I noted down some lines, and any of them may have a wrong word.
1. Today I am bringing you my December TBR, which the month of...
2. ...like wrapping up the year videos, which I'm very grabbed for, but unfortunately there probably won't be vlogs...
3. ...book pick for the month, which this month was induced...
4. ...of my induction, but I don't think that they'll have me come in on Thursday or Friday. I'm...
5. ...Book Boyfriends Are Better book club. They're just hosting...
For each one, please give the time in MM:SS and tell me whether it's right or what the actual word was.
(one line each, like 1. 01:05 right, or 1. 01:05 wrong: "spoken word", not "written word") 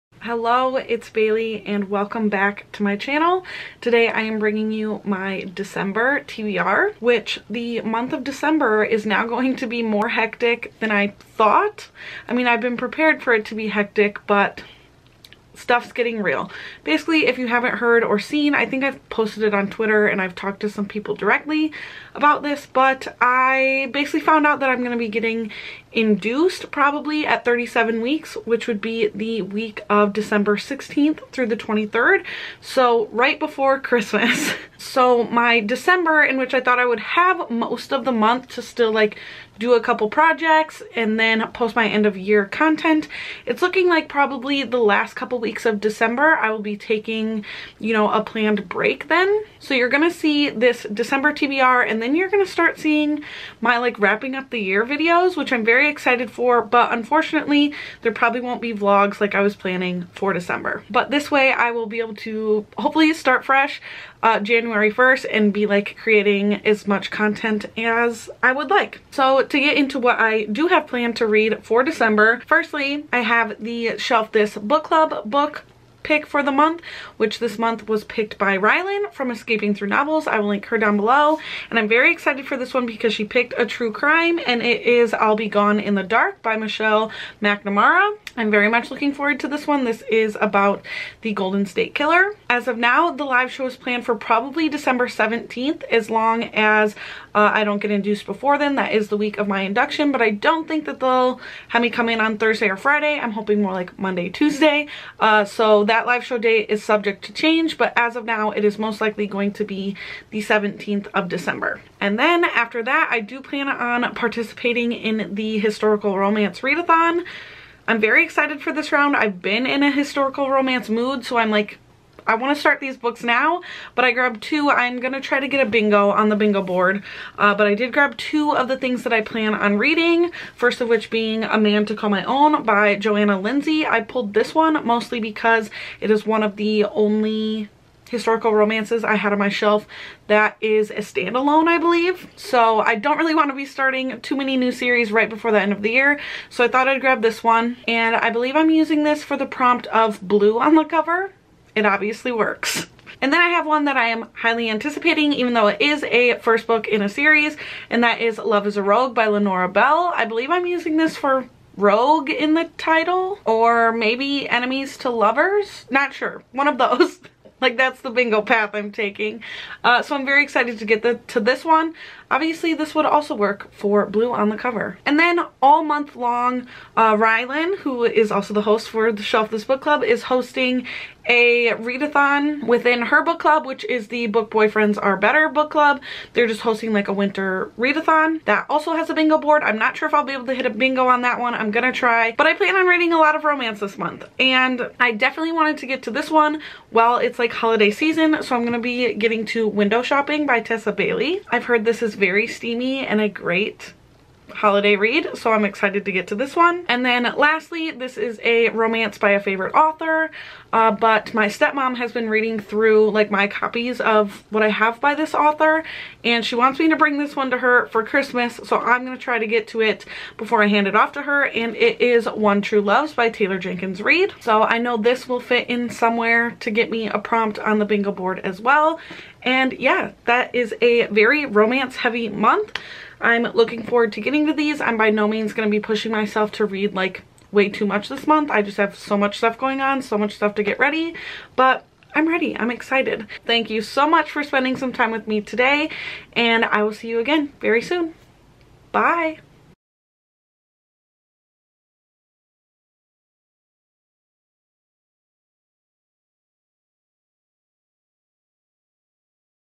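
1. 00:03 right
2. 00:53 wrong: "excited", not "grabbed"
3. 01:15 wrong: "picked", not "induced"
4. 01:39 right
5. 03:04 right.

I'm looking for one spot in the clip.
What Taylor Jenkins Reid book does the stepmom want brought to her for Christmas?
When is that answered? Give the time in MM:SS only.
03:42.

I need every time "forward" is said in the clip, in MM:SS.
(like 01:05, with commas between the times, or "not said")
01:29, 03:53.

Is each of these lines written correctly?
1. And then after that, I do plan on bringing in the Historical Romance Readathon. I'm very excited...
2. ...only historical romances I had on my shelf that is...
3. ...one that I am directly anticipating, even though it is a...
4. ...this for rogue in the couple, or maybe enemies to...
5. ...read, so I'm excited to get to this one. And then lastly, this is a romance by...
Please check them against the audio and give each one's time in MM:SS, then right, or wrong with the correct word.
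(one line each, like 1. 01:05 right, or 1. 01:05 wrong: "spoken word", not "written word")
1. 01:51 wrong: "participating", not "bringing"
2. 02:16 right
3. 02:33 wrong: "highly", not "directly"
4. 02:40 wrong: "title", not "couple"
5. 03:24 right.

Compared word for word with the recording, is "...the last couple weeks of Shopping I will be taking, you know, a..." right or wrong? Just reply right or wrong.
wrong.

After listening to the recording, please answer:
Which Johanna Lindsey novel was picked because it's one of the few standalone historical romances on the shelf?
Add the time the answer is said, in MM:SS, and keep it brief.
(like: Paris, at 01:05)
A Man to Call My Own, at 02:11.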